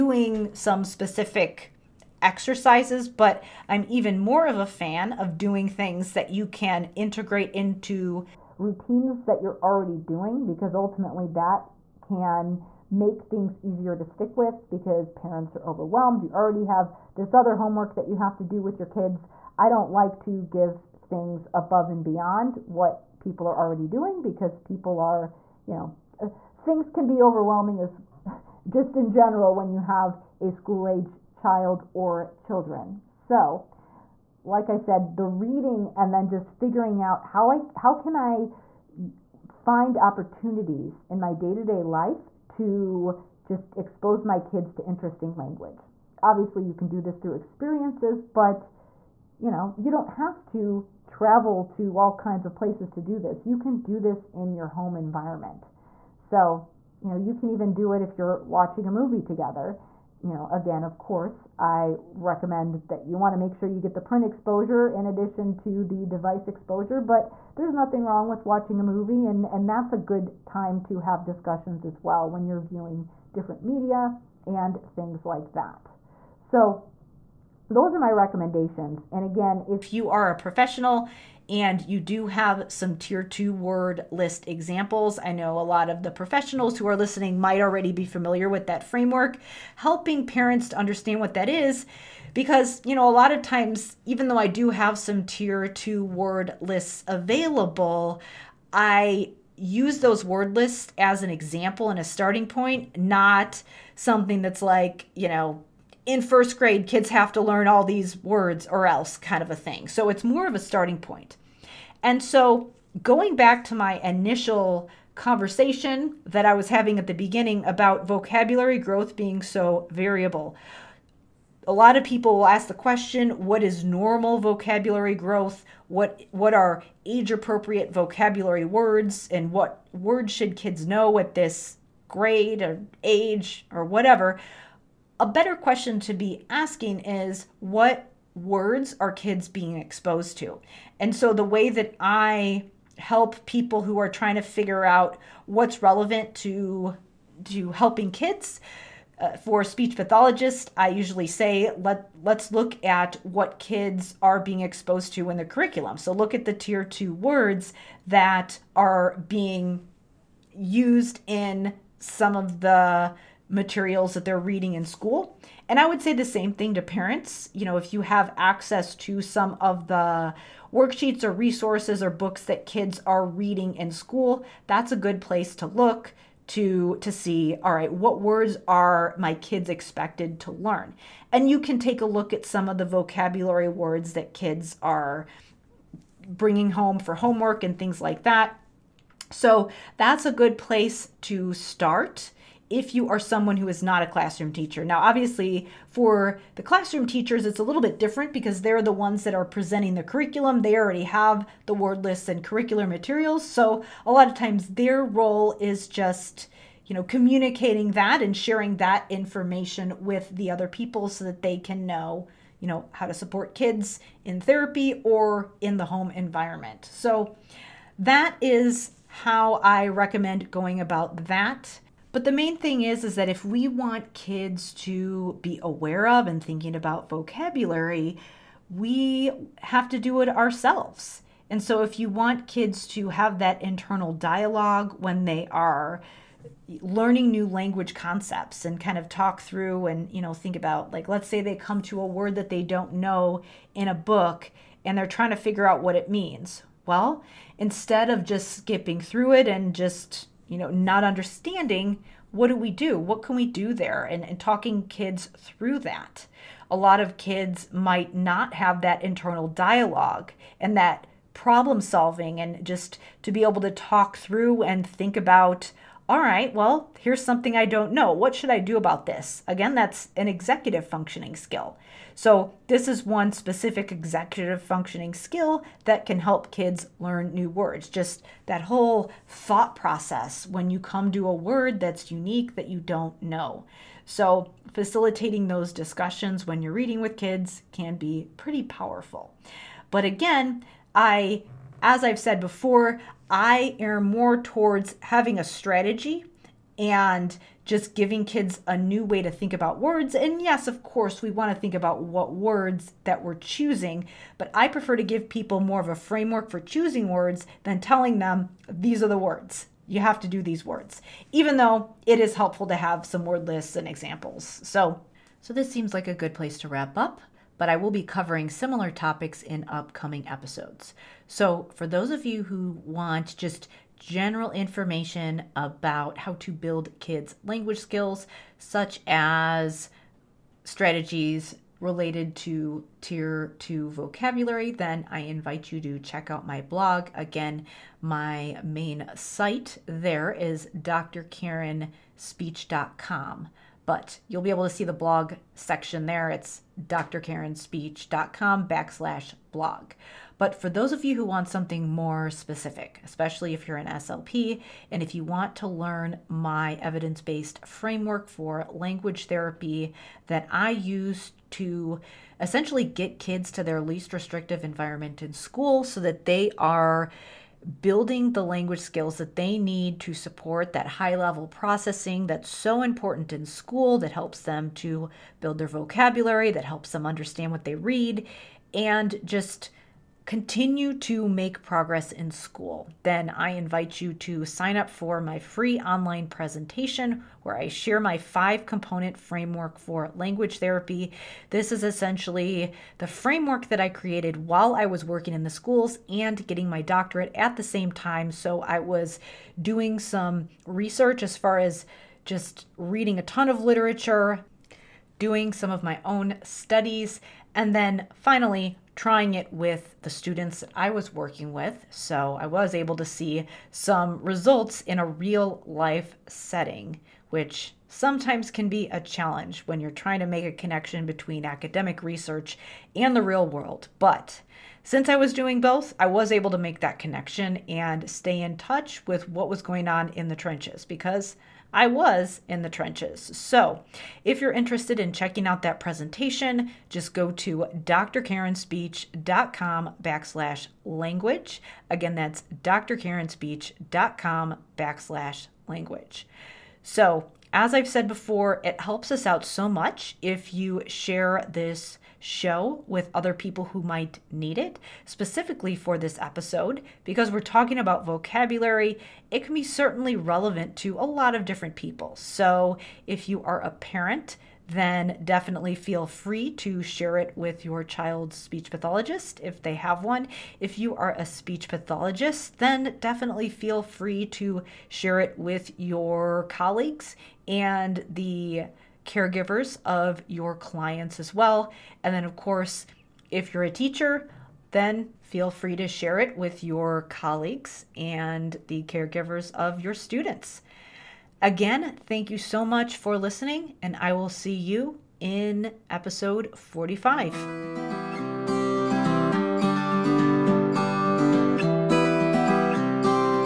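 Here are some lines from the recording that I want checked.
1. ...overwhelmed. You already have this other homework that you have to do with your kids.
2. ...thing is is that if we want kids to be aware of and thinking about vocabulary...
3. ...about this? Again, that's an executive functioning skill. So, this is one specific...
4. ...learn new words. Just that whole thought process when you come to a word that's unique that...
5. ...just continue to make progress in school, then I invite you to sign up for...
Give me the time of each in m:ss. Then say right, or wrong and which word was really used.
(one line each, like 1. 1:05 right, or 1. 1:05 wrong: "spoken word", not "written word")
1. 0:15 right
2. 3:42 right
3. 4:28 right
4. 4:36 right
5. 6:19 right.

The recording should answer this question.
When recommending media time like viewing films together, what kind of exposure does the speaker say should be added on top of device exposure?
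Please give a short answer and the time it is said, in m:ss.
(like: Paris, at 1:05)
print exposure, at 1:04.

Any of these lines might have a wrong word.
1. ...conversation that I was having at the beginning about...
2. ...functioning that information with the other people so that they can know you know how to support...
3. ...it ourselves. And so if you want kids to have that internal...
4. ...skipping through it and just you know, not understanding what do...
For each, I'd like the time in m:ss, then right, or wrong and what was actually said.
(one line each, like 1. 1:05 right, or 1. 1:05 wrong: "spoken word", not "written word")
1. 1:55 right
2. 3:28 wrong: "sharing", not "functioning"
3. 3:50 right
4. 4:08 right.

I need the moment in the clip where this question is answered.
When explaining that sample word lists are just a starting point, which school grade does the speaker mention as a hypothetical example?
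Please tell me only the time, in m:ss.
1:46.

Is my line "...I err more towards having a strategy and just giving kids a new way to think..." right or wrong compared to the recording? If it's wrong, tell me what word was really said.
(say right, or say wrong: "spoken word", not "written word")
right.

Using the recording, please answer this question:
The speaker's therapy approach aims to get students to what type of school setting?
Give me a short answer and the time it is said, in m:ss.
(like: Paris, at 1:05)
least restrictive environment, at 6:03.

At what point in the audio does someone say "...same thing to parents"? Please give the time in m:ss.
2:46.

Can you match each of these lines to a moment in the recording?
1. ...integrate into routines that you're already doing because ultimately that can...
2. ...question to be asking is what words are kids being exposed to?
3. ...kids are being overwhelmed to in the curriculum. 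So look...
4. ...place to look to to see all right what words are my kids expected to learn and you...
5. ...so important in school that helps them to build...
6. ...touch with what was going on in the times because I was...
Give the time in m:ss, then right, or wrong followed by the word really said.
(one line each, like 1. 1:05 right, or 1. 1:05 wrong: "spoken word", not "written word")
1. 0:06 right
2. 2:15 right
3. 2:33 wrong: "exposed", not "overwhelmed"
4. 2:55 right
5. 6:12 right
6. 7:08 wrong: "trenches", not "times".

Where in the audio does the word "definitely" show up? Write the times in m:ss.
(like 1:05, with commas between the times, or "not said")
7:45, 7:52.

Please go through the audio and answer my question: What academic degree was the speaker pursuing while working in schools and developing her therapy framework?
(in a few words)
doctorate.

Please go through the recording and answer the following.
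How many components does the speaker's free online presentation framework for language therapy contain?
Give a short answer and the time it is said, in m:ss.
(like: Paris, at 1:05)
5, at 6:28.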